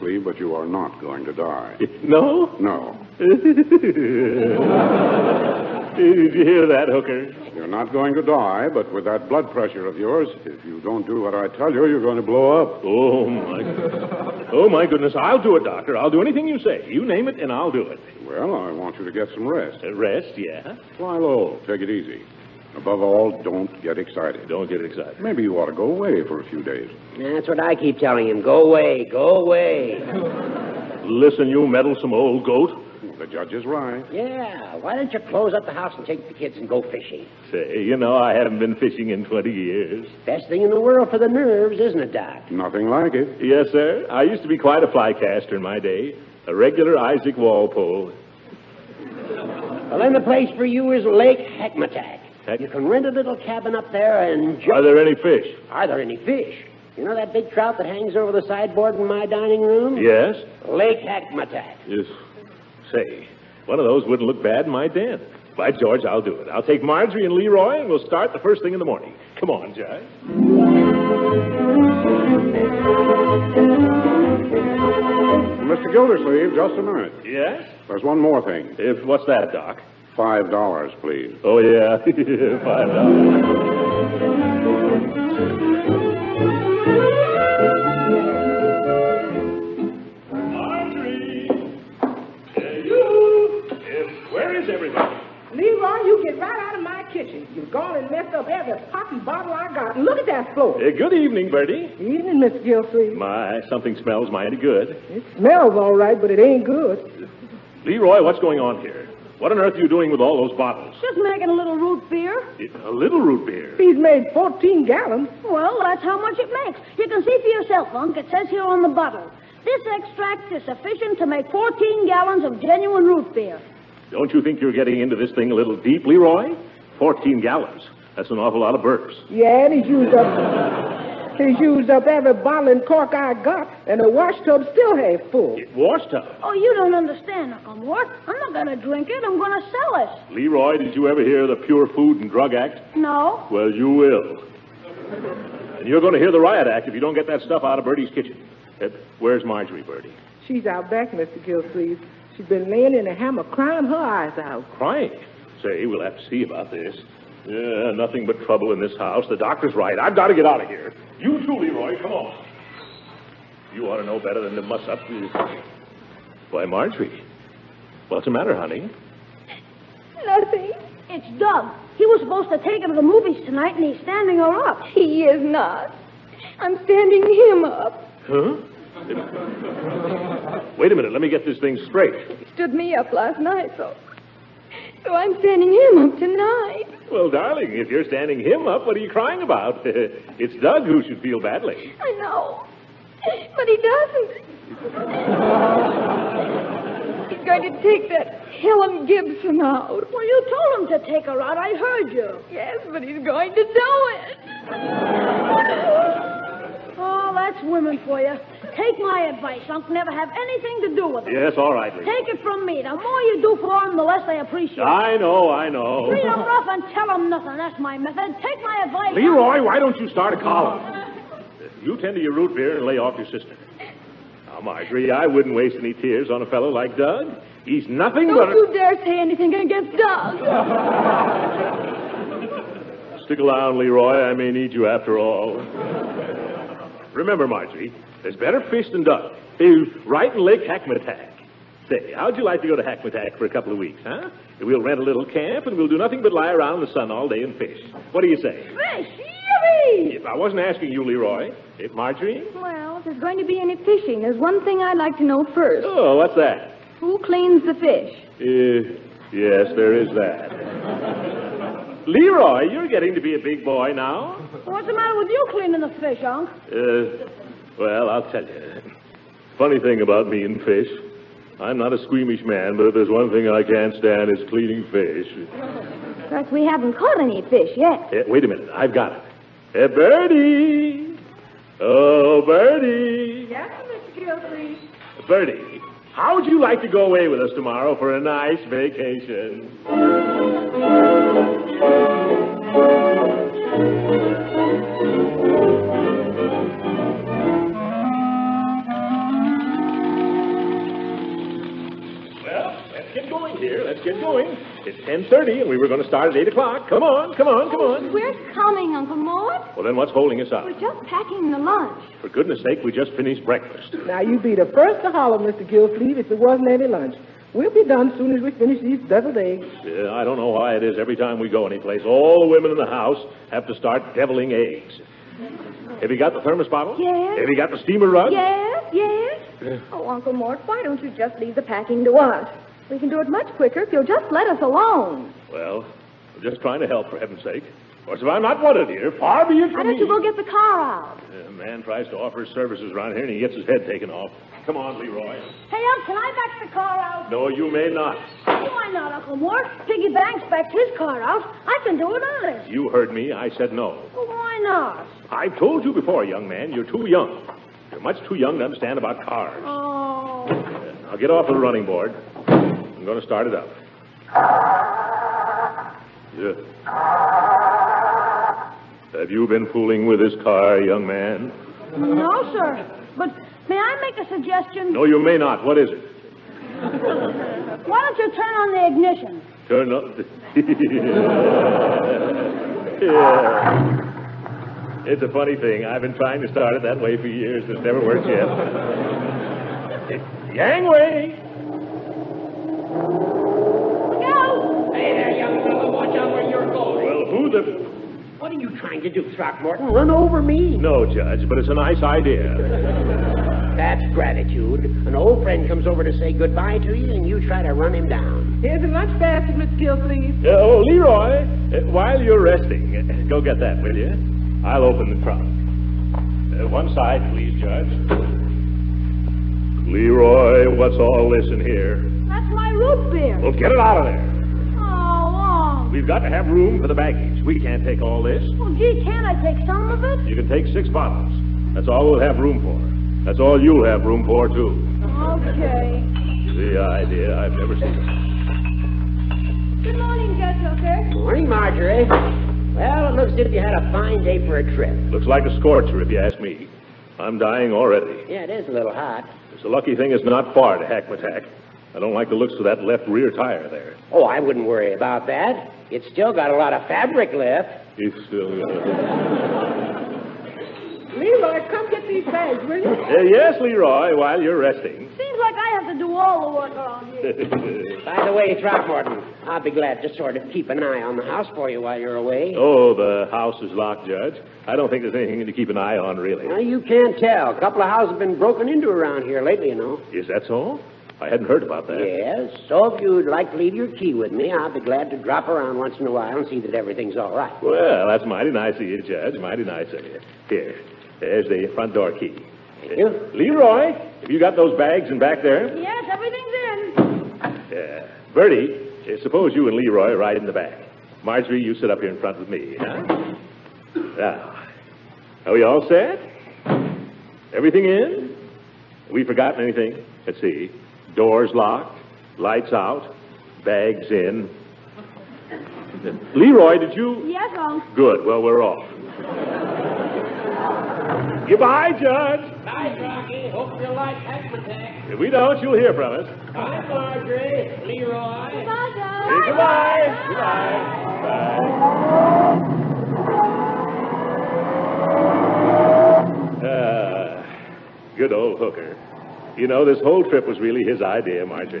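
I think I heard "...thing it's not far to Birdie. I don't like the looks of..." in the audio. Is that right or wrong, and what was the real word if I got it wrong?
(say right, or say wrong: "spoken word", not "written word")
wrong: "Hackmatack", not "Birdie".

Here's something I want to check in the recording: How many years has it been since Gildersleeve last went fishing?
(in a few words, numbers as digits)
20.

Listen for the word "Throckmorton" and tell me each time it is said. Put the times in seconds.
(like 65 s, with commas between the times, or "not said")
399 s, 468 s.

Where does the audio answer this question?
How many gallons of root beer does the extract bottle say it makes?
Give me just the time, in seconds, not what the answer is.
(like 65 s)
120 s.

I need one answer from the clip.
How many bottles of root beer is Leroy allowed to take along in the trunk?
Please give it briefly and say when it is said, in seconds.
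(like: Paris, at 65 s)
6, at 430 s.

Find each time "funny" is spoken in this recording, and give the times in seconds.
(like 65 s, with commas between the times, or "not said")
269 s, 385 s.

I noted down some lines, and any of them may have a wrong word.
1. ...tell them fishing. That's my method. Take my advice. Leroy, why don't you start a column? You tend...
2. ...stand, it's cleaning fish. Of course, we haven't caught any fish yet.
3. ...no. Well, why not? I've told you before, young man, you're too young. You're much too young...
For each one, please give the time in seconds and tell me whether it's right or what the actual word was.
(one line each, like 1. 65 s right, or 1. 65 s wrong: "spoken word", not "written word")
1. 216 s wrong: "nothing", not "fishing"
2. 273 s right
3. 353 s right.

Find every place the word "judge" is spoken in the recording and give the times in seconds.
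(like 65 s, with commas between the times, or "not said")
33 s, 401 s, 417 s, 440 s, 474 s, 489 s, 522 s, 528 s.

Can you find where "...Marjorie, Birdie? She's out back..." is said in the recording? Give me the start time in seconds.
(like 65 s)
149 s.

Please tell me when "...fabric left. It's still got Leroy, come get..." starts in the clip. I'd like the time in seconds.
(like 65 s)
456 s.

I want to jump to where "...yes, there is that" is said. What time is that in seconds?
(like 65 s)
259 s.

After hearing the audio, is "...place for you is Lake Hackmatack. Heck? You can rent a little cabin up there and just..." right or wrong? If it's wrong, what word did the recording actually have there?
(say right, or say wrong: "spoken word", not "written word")
right.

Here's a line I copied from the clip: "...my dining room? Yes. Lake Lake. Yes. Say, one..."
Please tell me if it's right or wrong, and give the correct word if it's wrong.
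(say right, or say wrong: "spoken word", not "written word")
wrong: "Hackmatack", not "Lake".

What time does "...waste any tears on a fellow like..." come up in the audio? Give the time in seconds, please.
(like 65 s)
225 s.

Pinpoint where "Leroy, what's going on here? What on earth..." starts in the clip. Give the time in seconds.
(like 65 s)
107 s.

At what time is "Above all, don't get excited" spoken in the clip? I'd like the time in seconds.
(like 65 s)
22 s.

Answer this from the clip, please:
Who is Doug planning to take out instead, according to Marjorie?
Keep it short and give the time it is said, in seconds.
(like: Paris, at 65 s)
Helen Gibson, at 198 s.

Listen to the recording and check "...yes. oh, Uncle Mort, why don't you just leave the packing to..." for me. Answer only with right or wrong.
right.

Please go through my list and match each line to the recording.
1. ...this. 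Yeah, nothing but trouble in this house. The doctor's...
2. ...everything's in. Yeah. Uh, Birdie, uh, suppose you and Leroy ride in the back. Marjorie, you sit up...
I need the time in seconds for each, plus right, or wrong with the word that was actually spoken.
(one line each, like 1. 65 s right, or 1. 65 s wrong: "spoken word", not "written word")
1. 156 s right
2. 496 s right.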